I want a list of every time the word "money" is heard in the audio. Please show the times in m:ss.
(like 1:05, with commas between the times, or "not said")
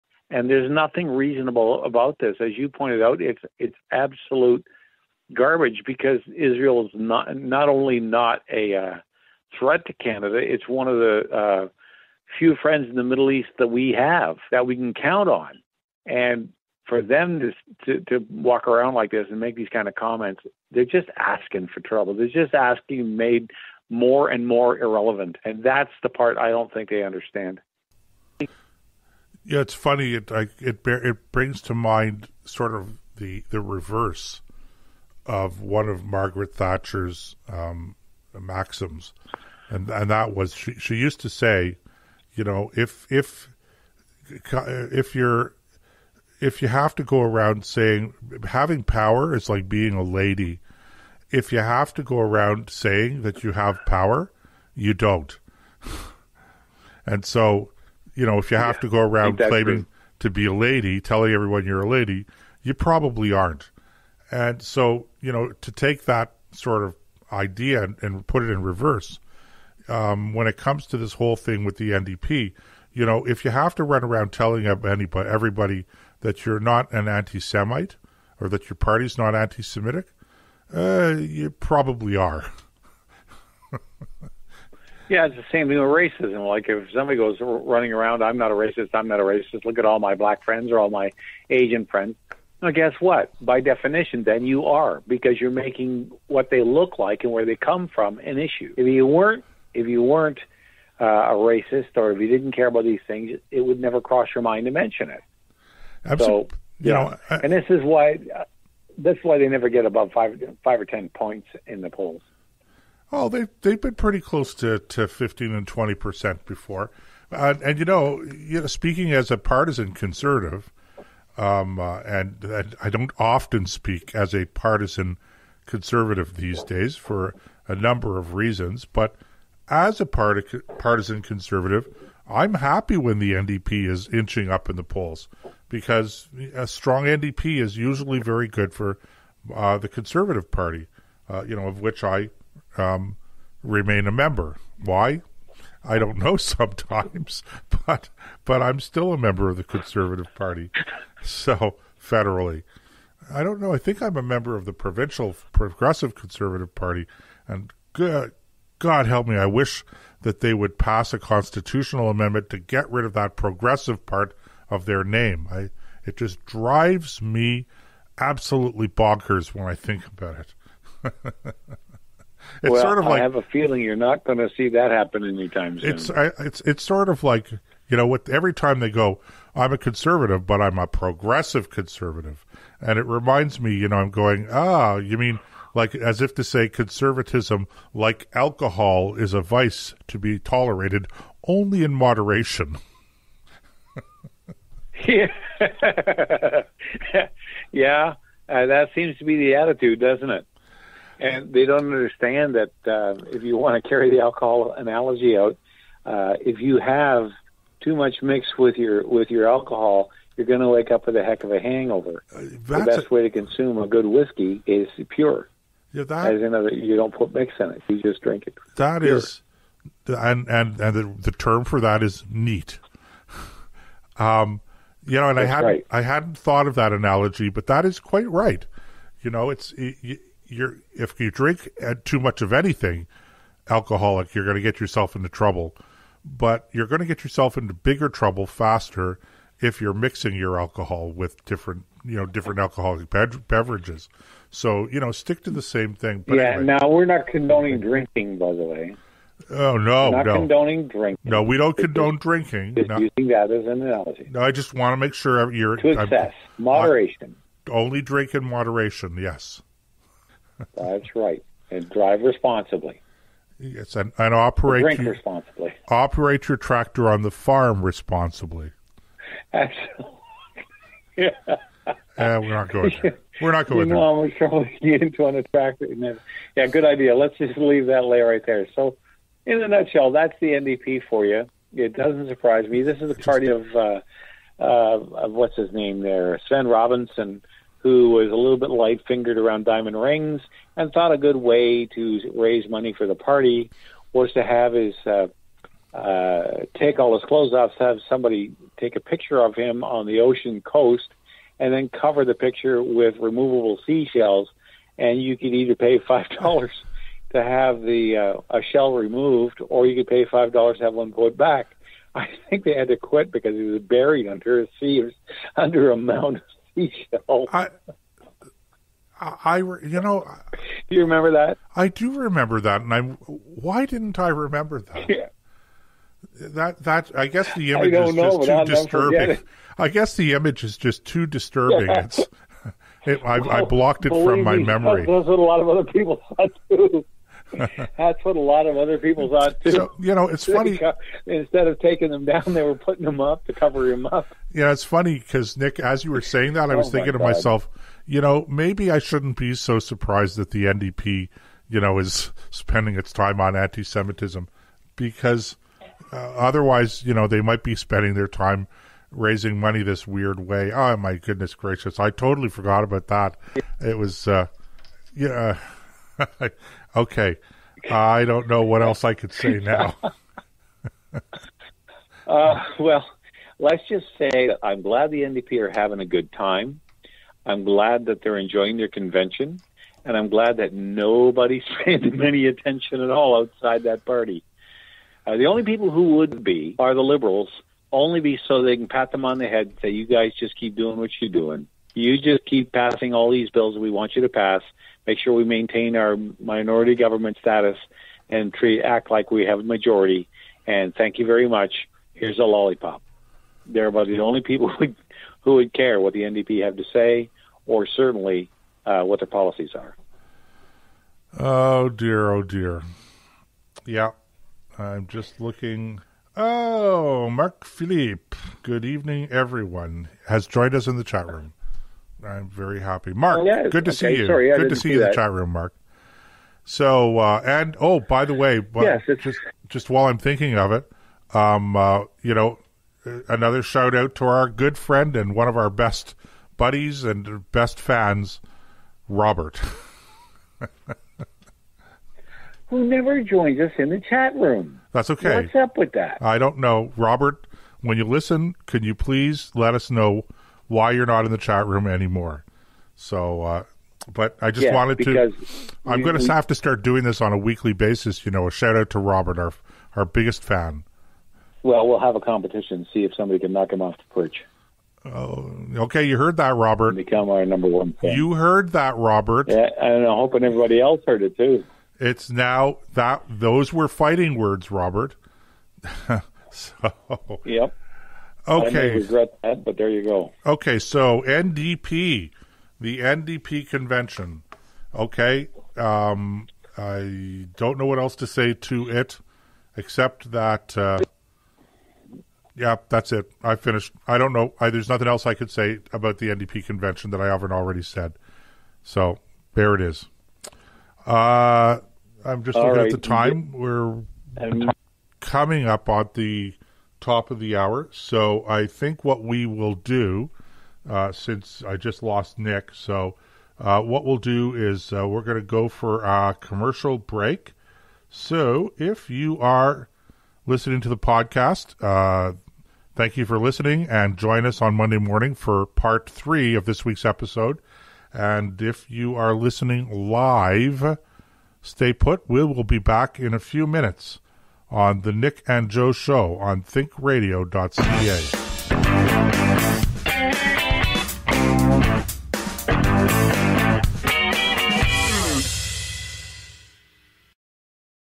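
4:52, 5:59.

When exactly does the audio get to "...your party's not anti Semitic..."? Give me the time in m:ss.
1:18.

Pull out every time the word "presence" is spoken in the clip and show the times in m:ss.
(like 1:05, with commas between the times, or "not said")
not said.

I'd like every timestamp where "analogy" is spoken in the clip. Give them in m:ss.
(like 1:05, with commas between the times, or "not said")
3:24, 3:46, 4:13.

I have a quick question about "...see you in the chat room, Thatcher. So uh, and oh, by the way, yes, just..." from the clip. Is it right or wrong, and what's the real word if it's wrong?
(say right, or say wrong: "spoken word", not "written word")
wrong: "Mark", not "Thatcher".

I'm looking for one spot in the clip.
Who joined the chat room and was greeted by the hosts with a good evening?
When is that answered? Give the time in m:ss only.
6:57.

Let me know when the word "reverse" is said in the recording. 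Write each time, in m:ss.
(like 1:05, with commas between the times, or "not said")
0:33, 1:08.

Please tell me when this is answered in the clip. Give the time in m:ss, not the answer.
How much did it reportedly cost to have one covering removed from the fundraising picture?
5:06.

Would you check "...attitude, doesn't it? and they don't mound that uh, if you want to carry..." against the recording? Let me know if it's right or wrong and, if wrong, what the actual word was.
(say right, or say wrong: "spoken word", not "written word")
wrong: "understand", not "mound".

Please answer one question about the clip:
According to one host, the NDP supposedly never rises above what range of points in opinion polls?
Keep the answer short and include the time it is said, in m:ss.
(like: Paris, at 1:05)
5 or 10 points, at 1:50.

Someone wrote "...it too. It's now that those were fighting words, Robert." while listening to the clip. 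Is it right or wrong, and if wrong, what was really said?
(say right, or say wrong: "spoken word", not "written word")
right.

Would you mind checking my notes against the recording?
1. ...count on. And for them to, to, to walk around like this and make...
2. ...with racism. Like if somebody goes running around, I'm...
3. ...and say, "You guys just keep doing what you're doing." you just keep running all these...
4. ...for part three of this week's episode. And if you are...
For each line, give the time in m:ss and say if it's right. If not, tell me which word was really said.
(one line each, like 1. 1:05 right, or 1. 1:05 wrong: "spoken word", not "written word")
1. 0:14 right
2. 1:25 right
3. 6:29 wrong: "passing", not "running"
4. 8:45 right.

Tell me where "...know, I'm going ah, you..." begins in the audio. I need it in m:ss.
3:03.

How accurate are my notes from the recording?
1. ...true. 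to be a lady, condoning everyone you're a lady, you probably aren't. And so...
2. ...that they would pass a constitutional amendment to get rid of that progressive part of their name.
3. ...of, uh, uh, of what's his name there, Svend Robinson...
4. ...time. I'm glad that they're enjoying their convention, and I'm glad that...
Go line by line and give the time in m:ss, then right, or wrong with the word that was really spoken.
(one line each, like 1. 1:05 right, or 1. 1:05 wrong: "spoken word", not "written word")
1. 0:59 wrong: "telling", not "condoning"
2. 2:40 right
3. 4:43 right
4. 6:16 right.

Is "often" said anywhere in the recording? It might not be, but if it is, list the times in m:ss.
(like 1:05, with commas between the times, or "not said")
2:03.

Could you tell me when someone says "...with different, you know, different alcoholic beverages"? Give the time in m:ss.
4:01.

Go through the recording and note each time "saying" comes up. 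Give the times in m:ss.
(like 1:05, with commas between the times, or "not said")
0:47, 0:52, 5:46.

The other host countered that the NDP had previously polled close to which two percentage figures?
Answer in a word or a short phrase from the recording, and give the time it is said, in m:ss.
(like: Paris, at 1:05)
15 and 20 percent, at 1:55.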